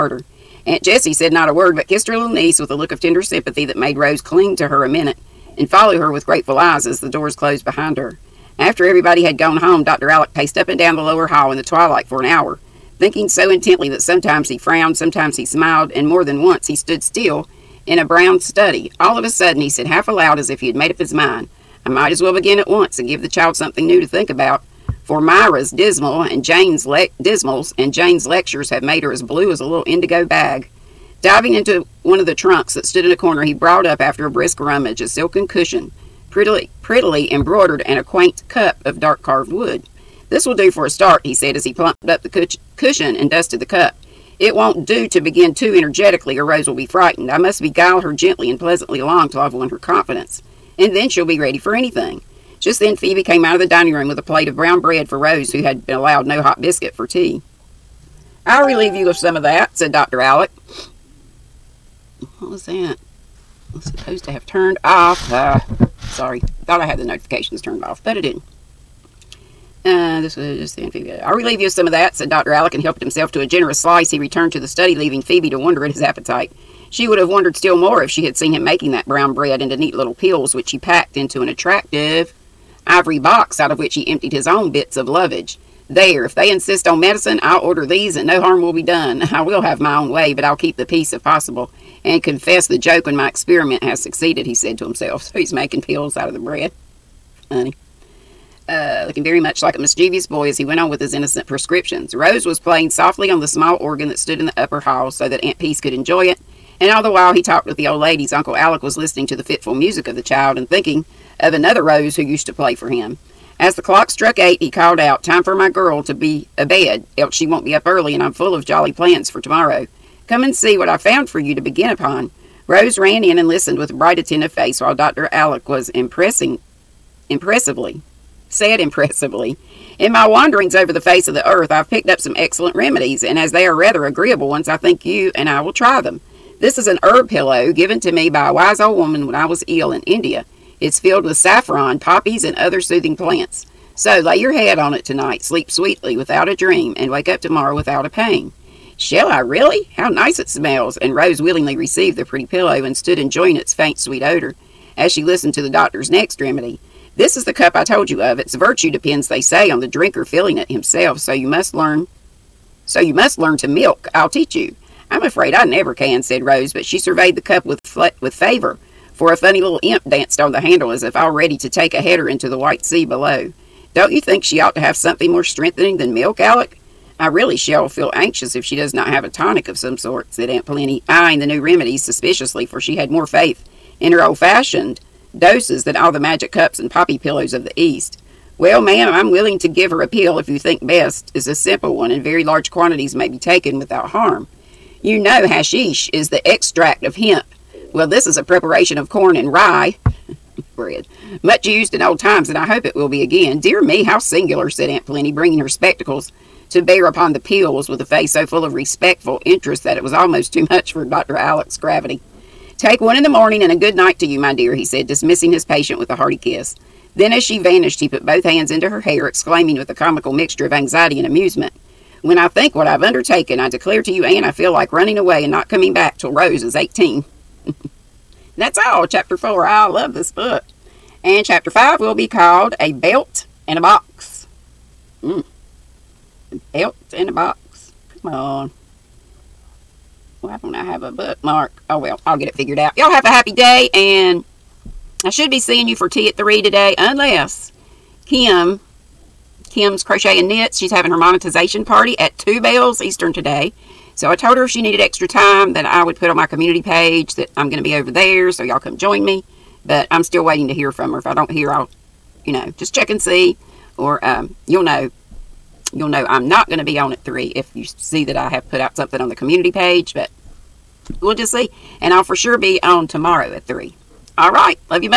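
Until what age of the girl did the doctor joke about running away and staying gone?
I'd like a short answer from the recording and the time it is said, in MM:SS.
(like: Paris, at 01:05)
18, at 03:46.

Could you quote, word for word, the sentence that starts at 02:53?
Don't you think she ought to have something more strengthening than milk, Alec?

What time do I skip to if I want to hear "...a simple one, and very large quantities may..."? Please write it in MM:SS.
03:11.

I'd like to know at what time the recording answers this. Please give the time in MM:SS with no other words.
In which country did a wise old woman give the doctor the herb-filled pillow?
02:20.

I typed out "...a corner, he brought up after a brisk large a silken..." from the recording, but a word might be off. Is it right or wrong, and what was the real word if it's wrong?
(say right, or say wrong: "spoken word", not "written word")
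wrong: "rummage", not "large".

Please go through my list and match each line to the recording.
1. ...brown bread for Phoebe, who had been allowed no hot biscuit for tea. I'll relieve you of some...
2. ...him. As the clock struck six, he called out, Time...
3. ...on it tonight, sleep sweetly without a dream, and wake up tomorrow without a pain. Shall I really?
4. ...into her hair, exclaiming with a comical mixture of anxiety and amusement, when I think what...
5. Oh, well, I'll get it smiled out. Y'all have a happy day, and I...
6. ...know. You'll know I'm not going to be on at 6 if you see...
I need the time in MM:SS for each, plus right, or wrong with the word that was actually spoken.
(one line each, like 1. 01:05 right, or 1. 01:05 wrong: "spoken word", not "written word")
1. 00:54 wrong: "Rose", not "Phoebe"
2. 01:52 wrong: "eight", not "six"
3. 02:24 right
4. 03:38 right
5. 04:01 wrong: "figured", not "smiled"
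6. 04:24 wrong: "3", not "6".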